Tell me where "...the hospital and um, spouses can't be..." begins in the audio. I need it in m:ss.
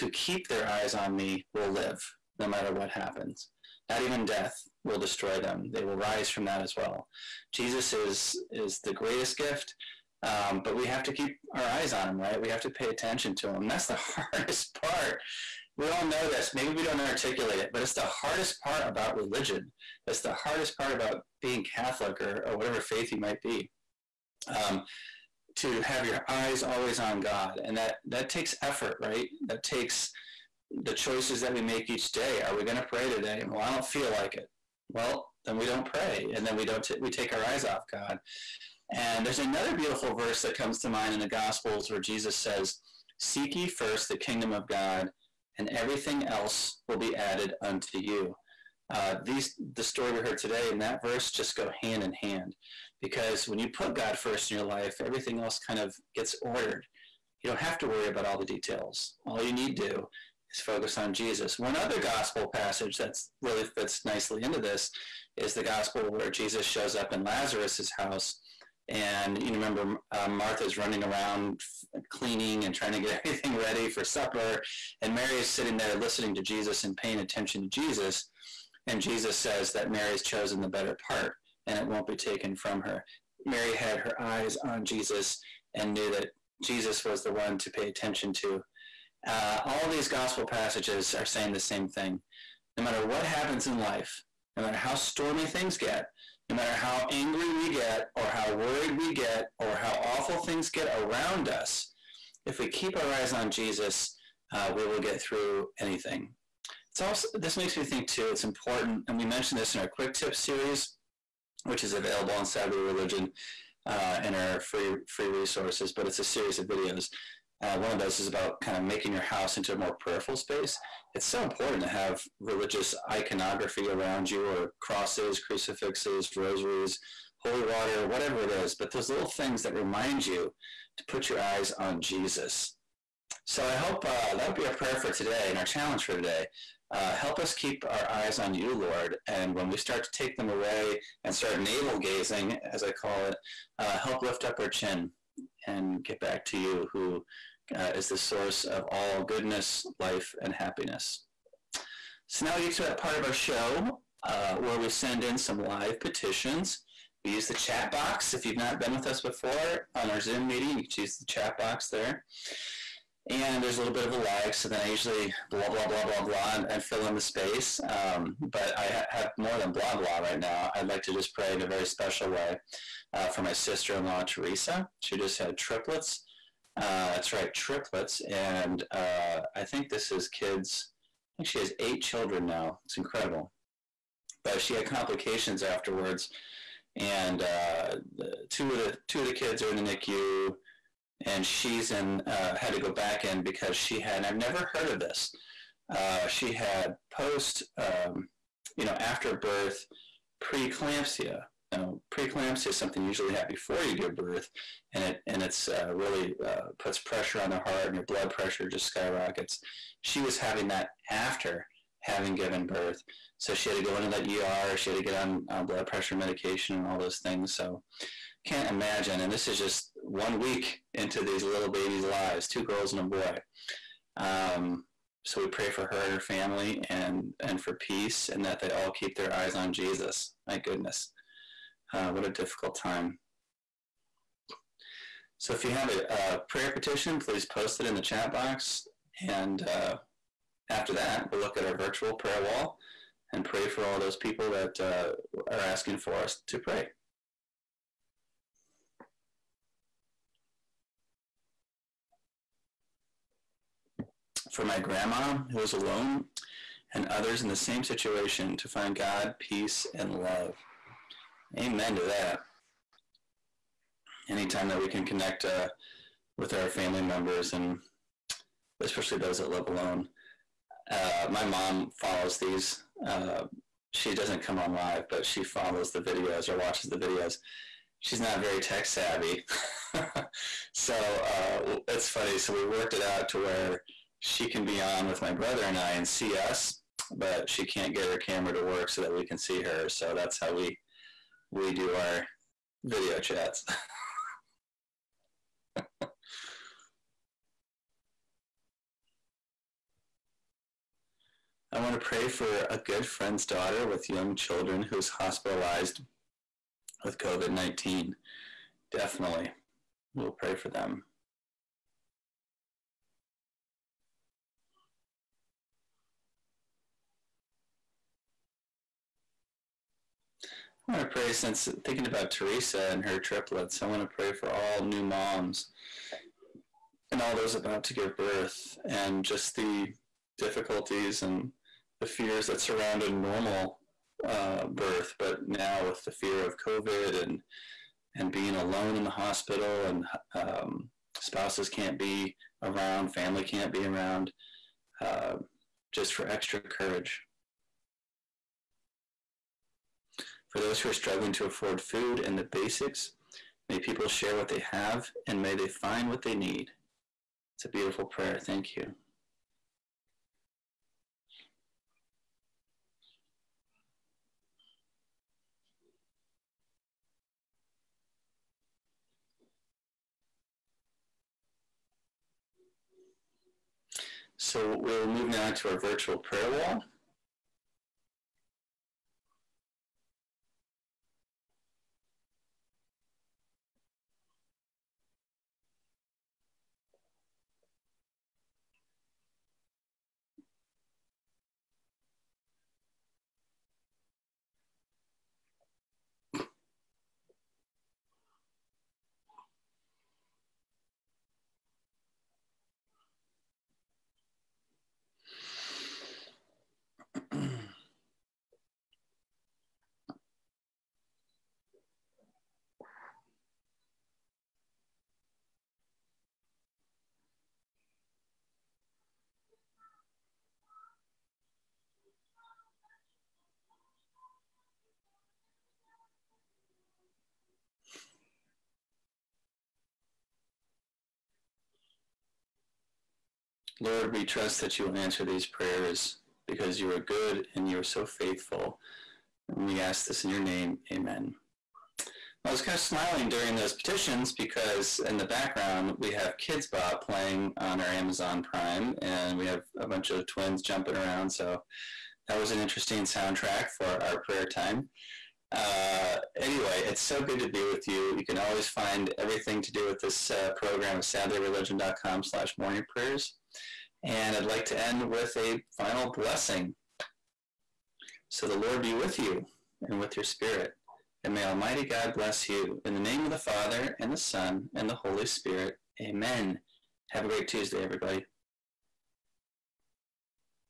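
5:39.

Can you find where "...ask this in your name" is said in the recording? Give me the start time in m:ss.
7:19.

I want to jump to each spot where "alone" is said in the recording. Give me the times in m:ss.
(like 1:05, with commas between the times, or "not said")
4:15, 4:29, 5:38.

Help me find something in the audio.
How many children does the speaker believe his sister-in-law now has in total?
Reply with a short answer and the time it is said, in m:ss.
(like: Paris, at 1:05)
8, at 3:01.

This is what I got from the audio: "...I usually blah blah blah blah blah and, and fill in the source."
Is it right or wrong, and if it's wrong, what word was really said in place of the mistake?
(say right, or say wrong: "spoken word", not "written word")
wrong: "space", not "source".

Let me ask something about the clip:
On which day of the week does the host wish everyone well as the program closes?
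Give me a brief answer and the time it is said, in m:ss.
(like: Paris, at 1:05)
Tuesday, at 7:57.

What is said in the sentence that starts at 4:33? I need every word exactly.
Uh, she doesn't come on live, but she follows the videos or watches the videos.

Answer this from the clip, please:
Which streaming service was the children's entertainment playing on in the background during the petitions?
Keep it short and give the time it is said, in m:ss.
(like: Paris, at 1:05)
Amazon Prime, at 7:27.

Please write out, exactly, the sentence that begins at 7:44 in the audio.
And I'd like to end with a final blessing.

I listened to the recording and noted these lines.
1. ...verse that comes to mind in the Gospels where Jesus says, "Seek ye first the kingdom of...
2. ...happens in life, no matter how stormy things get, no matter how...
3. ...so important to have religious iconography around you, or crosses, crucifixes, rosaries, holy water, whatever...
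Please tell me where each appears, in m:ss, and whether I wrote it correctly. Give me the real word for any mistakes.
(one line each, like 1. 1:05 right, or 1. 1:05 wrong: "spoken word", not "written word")
1. 0:40 right
2. 1:33 right
3. 2:01 right.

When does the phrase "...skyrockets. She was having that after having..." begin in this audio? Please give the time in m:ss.
3:28.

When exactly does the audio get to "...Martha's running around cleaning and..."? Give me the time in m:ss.
1:10.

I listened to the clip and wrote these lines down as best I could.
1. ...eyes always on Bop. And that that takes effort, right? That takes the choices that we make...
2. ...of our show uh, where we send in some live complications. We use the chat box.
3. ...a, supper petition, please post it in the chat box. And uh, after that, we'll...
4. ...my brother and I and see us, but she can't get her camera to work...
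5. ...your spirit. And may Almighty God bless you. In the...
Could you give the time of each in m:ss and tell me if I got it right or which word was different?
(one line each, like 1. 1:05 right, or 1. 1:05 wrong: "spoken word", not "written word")
1. 0:26 wrong: "God", not "Bop"
2. 2:33 wrong: "petitions", not "complications"
3. 3:56 wrong: "prayer", not "supper"
4. 4:45 right
5. 7:50 right.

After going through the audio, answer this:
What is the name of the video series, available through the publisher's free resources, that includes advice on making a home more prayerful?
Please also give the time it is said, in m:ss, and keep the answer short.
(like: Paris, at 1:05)
quick tip series, at 1:49.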